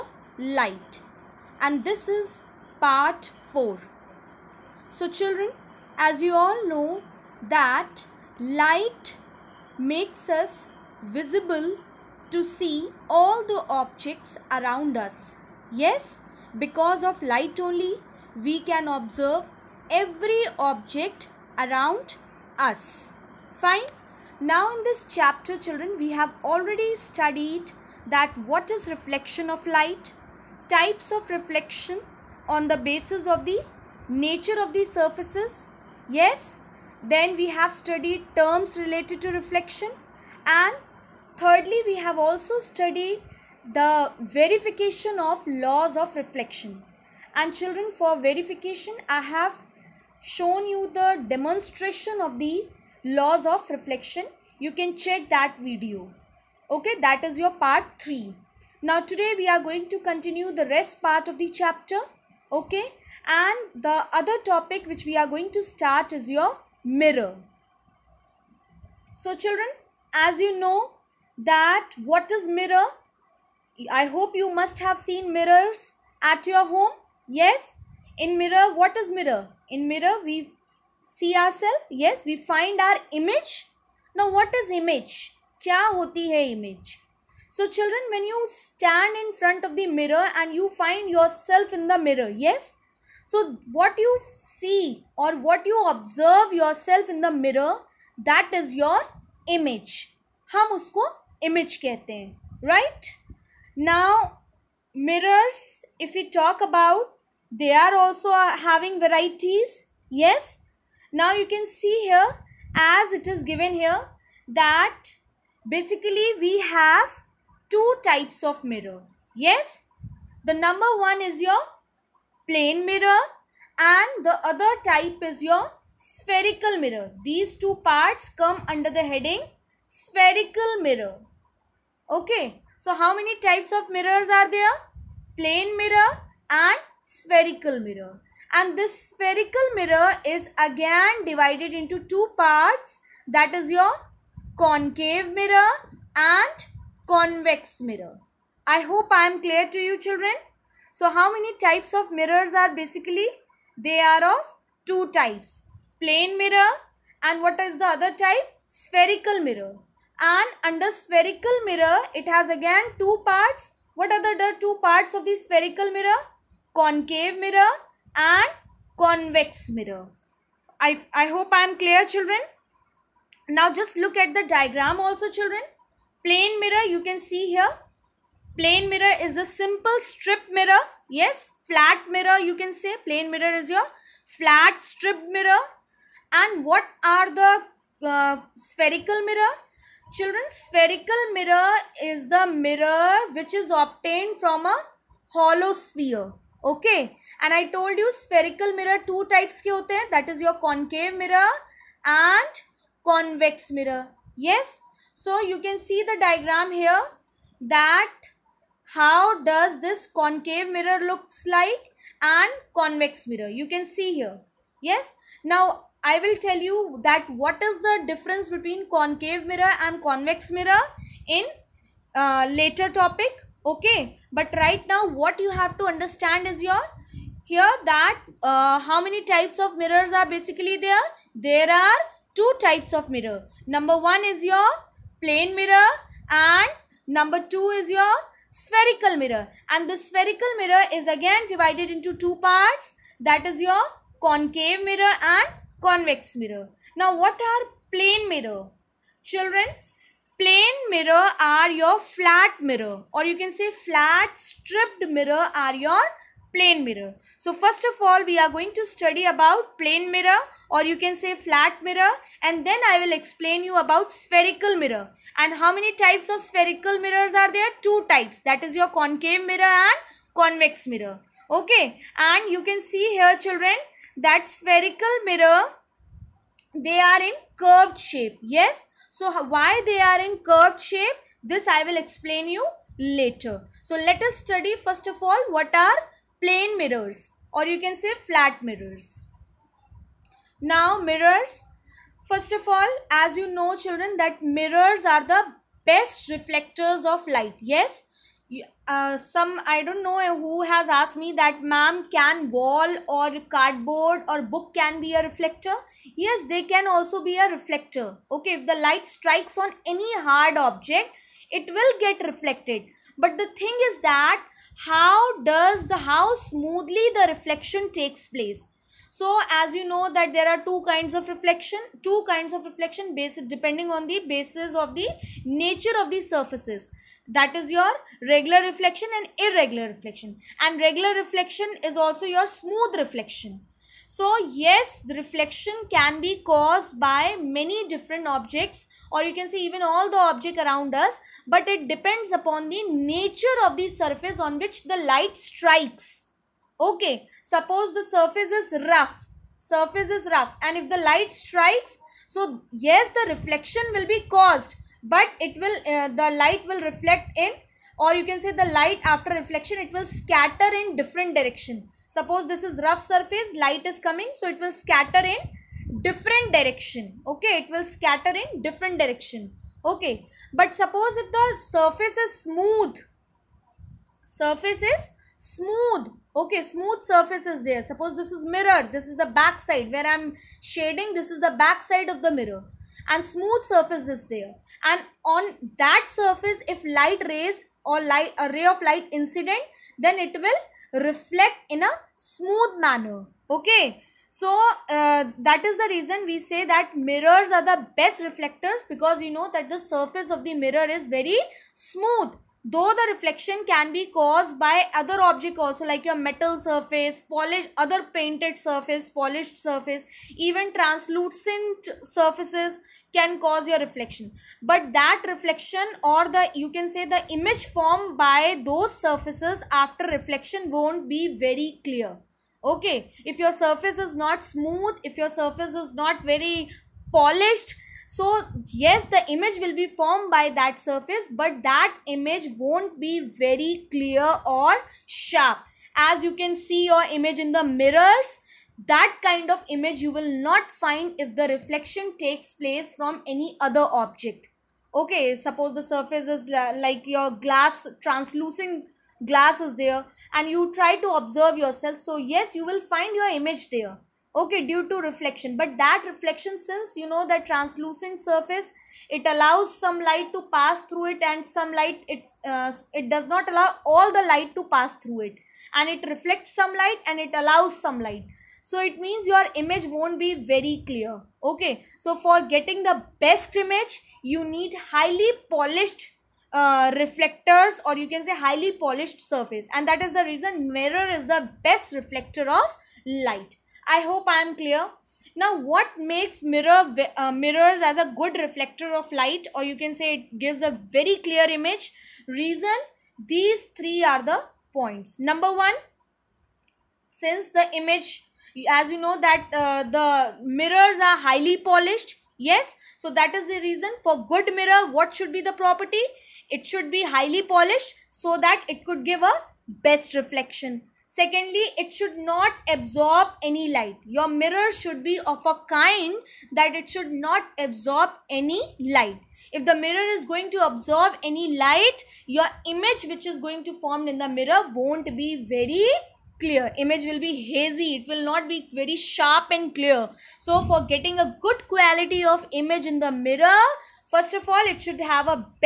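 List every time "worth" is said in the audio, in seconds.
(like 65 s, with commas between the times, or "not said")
not said.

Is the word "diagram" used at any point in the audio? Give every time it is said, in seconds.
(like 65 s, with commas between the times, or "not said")
174 s, 206 s.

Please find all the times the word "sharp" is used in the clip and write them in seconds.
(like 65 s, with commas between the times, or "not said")
435 s, 528 s.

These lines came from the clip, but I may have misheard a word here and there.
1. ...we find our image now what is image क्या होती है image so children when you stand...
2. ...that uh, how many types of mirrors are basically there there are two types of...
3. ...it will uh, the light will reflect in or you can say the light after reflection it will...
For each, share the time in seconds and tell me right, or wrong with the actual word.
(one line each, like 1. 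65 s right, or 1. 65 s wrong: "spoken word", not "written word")
1. 82 s right
2. 227 s right
3. 355 s right.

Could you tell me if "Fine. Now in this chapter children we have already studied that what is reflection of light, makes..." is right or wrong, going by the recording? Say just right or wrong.
wrong.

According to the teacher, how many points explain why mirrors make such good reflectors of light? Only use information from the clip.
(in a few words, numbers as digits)
3.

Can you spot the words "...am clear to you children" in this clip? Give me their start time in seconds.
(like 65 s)
149 s.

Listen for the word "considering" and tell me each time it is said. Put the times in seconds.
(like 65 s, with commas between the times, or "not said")
not said.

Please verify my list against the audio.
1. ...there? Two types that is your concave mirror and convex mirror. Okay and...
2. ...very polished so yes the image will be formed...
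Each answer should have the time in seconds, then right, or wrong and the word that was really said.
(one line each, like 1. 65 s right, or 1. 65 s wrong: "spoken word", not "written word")
1. 267 s right
2. 426 s right.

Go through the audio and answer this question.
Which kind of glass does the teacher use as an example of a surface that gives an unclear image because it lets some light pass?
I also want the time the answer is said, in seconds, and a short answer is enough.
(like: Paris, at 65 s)
Translucent glass, at 448 s.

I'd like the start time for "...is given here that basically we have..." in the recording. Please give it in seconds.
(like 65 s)
113 s.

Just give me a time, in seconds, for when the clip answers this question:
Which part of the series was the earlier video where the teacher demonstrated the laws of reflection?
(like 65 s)
57 s.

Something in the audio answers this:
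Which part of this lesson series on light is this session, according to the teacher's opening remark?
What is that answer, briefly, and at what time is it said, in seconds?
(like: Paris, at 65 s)
Part 4, at 2 s.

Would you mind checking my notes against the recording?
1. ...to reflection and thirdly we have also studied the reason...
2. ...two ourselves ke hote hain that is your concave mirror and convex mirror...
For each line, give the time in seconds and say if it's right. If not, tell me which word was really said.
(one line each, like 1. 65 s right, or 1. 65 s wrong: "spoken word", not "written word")
1. 39 s wrong: "verification", not "reason"
2. 199 s wrong: "types", not "ourselves".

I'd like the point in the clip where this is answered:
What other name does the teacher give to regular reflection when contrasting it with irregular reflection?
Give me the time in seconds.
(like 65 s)
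332 s.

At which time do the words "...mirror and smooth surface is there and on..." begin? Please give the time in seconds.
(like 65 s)
382 s.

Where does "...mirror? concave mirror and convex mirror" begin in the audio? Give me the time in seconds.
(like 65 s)
165 s.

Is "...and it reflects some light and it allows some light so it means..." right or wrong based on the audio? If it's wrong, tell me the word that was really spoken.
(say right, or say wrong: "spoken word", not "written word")
right.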